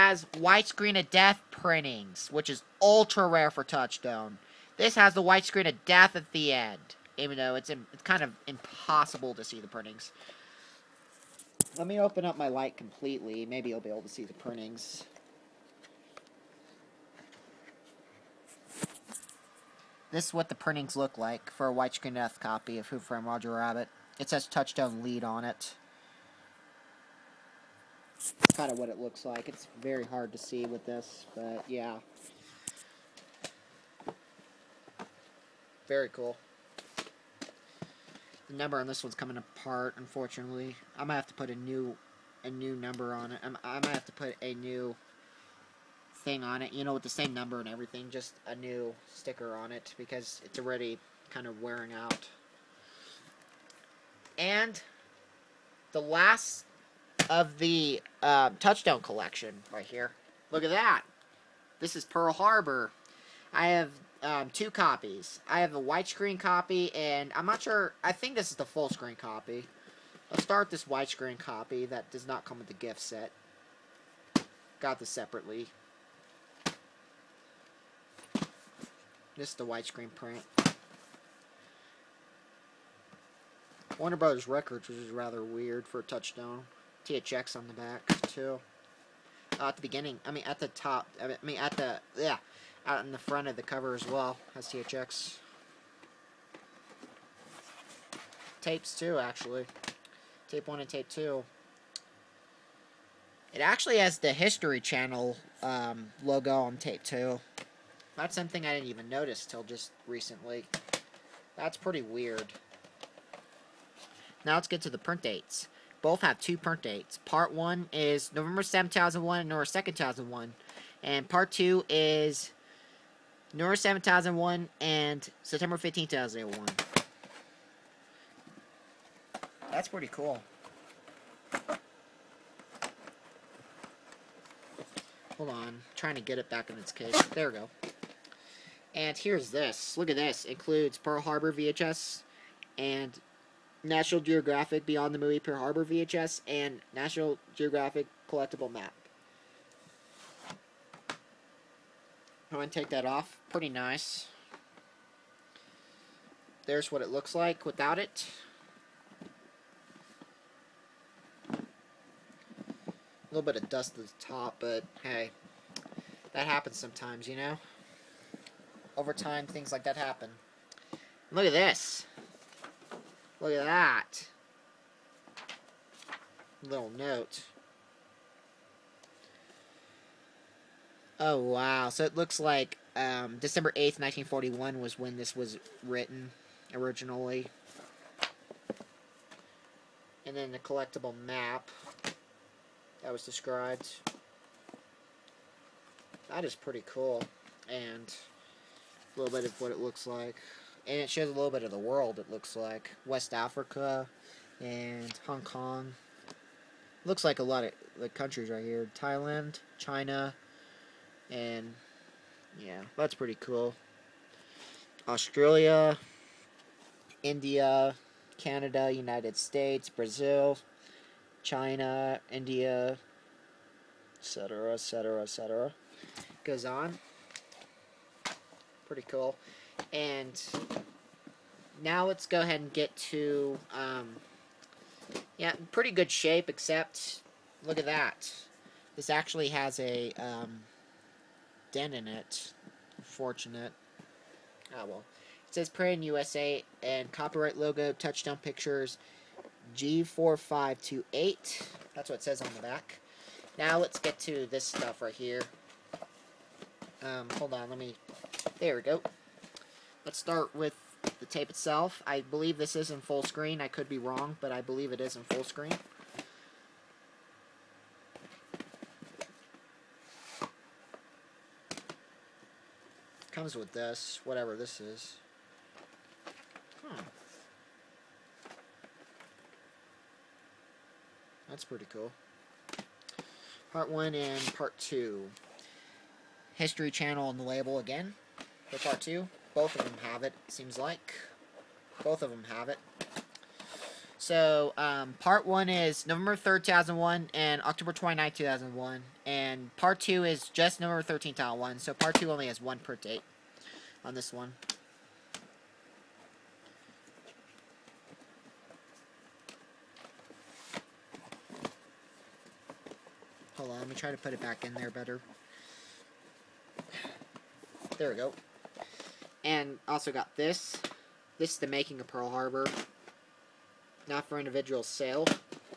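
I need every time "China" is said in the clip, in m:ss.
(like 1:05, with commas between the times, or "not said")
3:29, 3:41.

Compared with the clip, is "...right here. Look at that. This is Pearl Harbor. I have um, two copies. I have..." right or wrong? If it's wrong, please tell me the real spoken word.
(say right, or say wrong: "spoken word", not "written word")
right.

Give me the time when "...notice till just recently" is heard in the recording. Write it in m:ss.
1:49.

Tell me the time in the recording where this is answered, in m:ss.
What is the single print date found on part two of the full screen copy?
5:00.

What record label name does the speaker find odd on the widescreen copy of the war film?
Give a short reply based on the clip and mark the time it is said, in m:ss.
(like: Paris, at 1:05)
Warner Brothers Records, at 1:23.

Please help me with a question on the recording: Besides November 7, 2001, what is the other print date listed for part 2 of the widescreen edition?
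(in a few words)
September 15, 2001.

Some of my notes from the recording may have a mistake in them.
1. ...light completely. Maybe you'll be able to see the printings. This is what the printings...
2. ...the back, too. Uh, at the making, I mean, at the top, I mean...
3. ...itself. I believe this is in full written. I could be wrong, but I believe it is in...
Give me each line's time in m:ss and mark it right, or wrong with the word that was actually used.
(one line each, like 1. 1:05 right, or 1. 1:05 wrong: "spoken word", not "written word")
1. 0:12 right
2. 1:27 wrong: "beginning", not "making"
3. 4:21 wrong: "screen", not "written".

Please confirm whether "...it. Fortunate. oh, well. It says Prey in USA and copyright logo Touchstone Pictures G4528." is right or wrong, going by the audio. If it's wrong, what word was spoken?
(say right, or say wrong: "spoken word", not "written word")
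right.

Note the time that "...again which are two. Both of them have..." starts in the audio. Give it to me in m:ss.
4:47.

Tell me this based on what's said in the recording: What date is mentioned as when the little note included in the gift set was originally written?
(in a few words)
December 8th, 1941.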